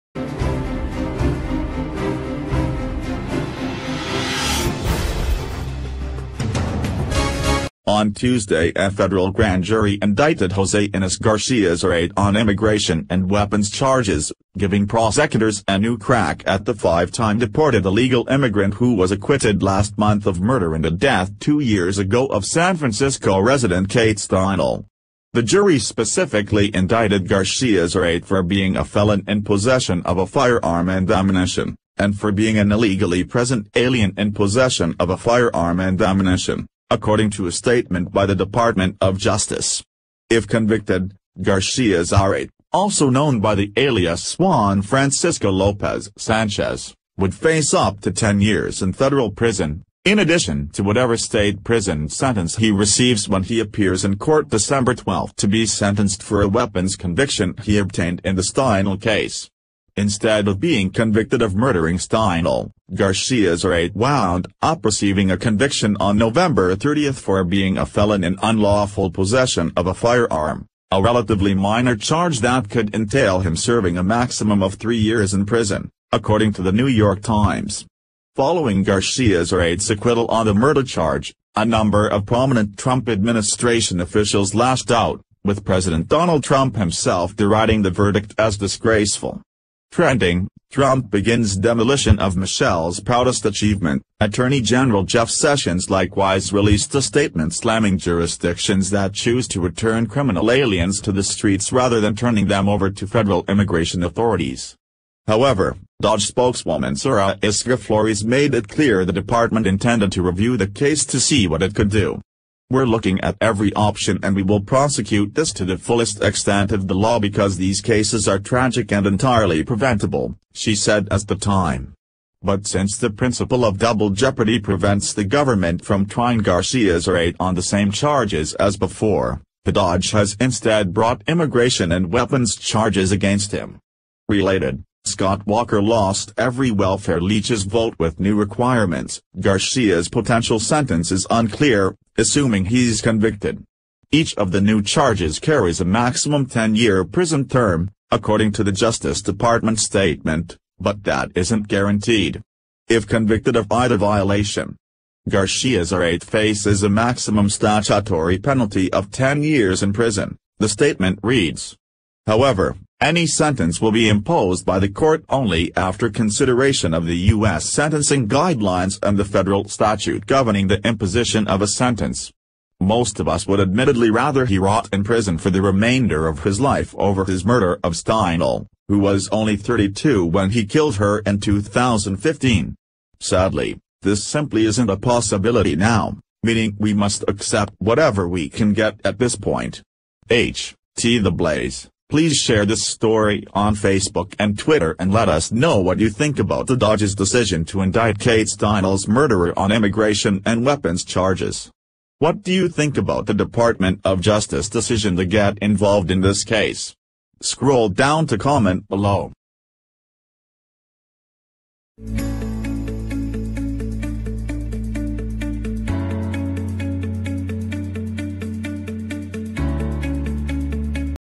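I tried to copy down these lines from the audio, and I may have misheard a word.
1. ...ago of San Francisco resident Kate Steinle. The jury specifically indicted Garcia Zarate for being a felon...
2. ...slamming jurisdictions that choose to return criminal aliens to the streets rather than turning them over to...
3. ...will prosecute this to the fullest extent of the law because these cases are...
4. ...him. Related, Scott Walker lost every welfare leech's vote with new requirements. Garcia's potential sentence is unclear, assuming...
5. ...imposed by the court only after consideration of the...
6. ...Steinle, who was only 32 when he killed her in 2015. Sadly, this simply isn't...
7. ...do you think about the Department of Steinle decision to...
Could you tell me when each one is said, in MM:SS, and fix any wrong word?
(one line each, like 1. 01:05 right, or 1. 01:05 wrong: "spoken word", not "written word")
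1. 00:21 right
2. 01:37 right
3. 01:54 right
4. 02:13 right
5. 02:44 right
6. 02:57 right
7. 03:22 wrong: "Justice", not "Steinle".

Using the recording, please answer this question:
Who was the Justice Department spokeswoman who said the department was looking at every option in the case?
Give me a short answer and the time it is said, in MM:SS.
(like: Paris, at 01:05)
Sarah Isgur Flores, at 01:46.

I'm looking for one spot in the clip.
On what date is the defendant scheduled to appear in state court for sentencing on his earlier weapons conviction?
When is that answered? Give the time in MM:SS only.
00:54.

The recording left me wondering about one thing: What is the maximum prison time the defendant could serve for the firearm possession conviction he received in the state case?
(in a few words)
3 years.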